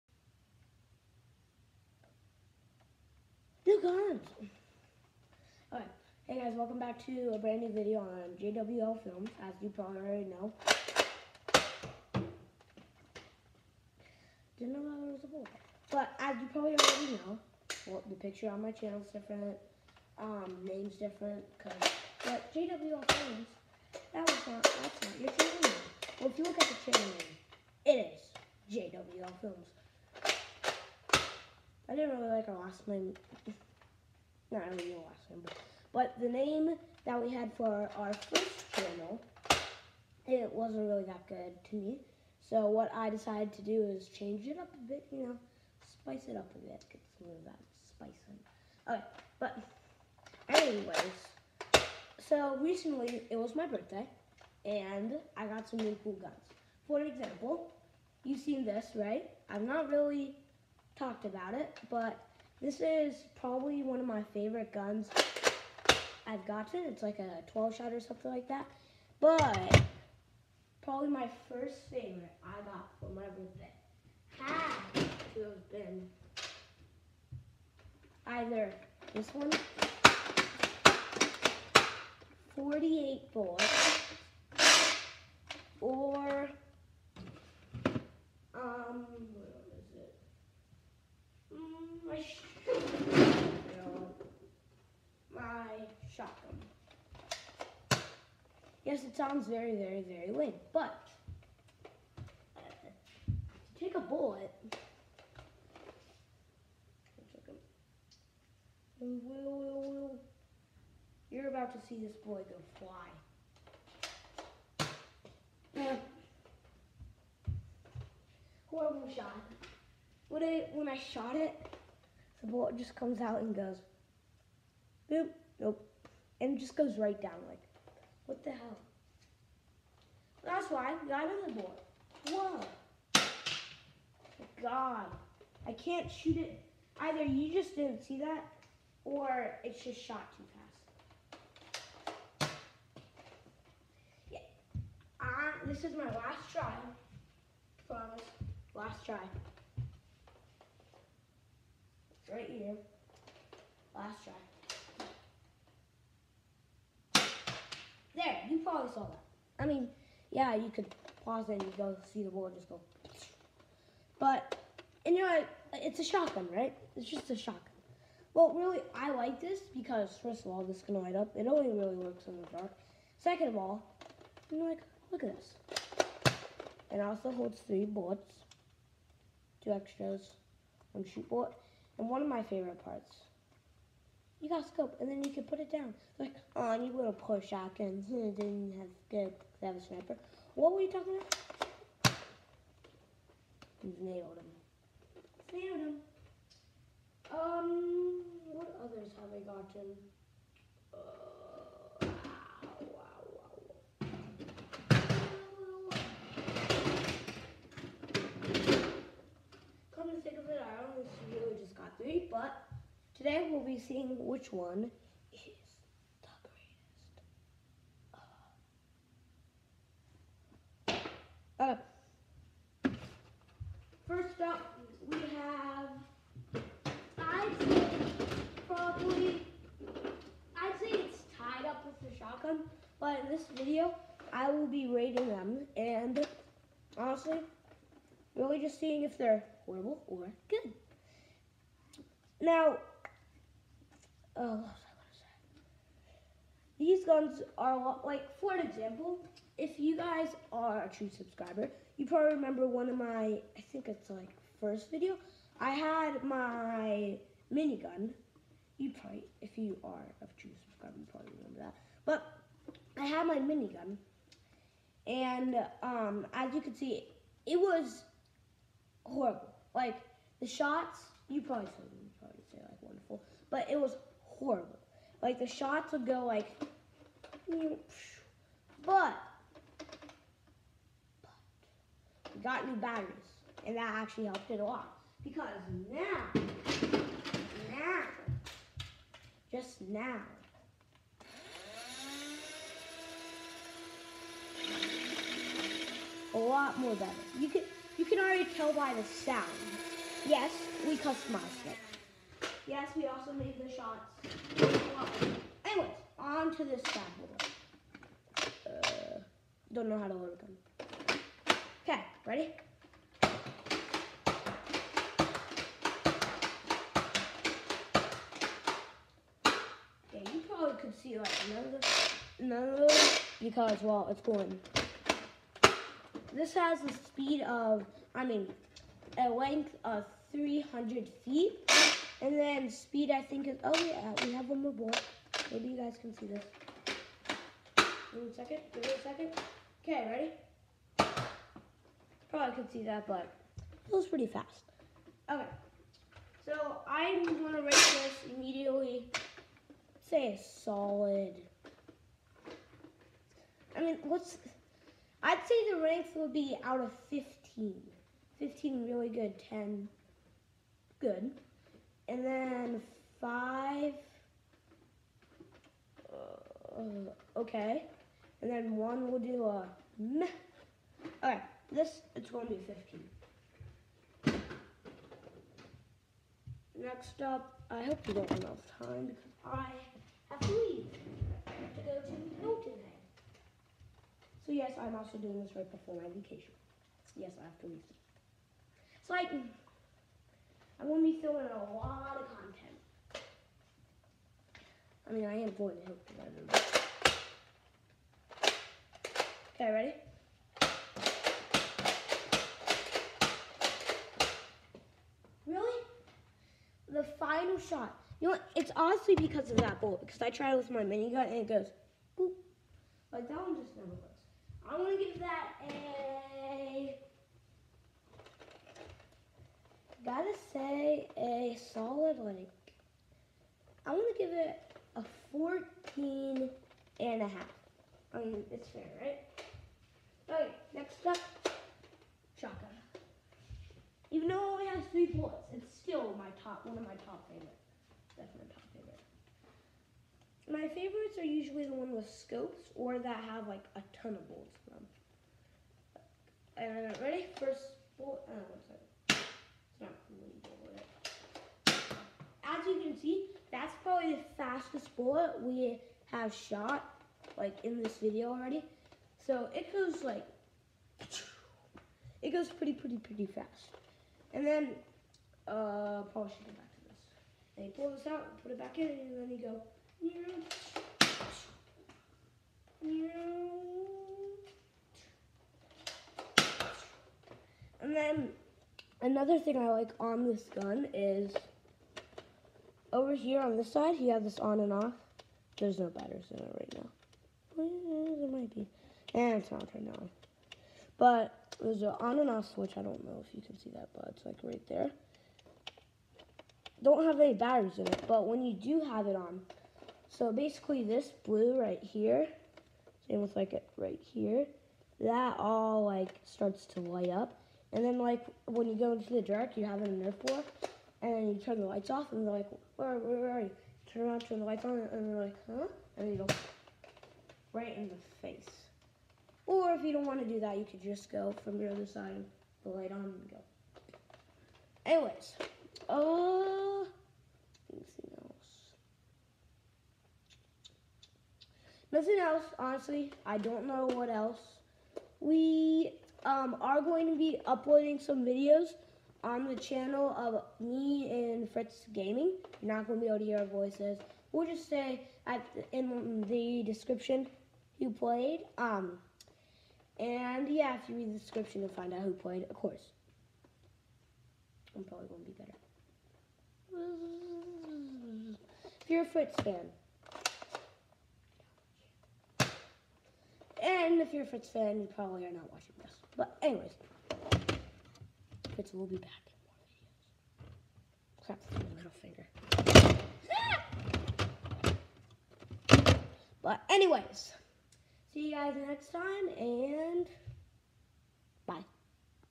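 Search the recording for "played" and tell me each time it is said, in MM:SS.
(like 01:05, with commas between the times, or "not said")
09:07, 09:12.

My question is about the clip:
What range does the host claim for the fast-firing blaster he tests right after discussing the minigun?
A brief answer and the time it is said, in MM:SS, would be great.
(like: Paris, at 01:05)
300 feet, at 05:30.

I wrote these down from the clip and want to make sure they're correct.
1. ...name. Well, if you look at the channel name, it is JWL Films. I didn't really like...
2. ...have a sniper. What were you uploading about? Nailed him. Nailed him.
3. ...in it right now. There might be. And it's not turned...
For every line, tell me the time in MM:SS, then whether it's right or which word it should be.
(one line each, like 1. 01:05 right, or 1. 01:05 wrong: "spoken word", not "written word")
1. 00:25 right
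2. 03:09 wrong: "talking", not "uploading"
3. 08:06 right.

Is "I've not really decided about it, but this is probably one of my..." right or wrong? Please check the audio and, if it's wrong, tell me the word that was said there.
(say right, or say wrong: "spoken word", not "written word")
wrong: "talked", not "decided".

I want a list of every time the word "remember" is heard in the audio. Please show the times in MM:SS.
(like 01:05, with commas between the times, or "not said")
04:12, 04:21.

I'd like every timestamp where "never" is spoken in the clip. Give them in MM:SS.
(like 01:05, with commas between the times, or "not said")
06:53.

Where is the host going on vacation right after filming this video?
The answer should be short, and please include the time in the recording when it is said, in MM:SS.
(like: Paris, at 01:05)
Hilton Head, at 06:22.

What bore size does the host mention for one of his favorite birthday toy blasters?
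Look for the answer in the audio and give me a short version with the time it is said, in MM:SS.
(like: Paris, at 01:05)
48, at 01:22.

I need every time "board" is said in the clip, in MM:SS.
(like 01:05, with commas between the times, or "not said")
02:11, 02:42.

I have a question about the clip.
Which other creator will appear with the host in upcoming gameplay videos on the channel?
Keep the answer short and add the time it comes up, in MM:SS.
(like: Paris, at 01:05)
Fritz Gaming, at 09:01.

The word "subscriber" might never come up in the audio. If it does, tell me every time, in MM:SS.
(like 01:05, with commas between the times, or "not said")
04:11, 04:20.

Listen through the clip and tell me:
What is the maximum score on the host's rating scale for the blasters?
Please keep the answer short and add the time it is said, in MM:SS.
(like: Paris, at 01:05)
15, at 05:56.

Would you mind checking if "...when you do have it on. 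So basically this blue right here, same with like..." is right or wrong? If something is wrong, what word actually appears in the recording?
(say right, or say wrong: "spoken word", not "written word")
right.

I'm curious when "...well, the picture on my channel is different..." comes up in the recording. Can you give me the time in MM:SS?
00:17.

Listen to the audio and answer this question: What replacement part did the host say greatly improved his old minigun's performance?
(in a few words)
new batteries.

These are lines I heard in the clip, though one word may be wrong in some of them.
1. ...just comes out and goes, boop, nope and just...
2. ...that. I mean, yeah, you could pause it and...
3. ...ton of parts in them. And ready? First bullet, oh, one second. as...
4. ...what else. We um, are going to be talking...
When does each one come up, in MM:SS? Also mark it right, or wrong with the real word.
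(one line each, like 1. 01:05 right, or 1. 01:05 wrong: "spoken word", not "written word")
1. 02:02 right
2. 02:39 right
3. 07:24 wrong: "bullets", not "parts"
4. 08:53 wrong: "uploading", not "talking".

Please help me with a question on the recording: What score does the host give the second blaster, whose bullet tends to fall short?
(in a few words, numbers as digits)
14 and a half.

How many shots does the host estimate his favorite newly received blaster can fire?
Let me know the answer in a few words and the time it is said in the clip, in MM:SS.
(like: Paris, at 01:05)
12, at 01:07.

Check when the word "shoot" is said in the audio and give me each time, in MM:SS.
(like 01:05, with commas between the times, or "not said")
02:16, 03:01.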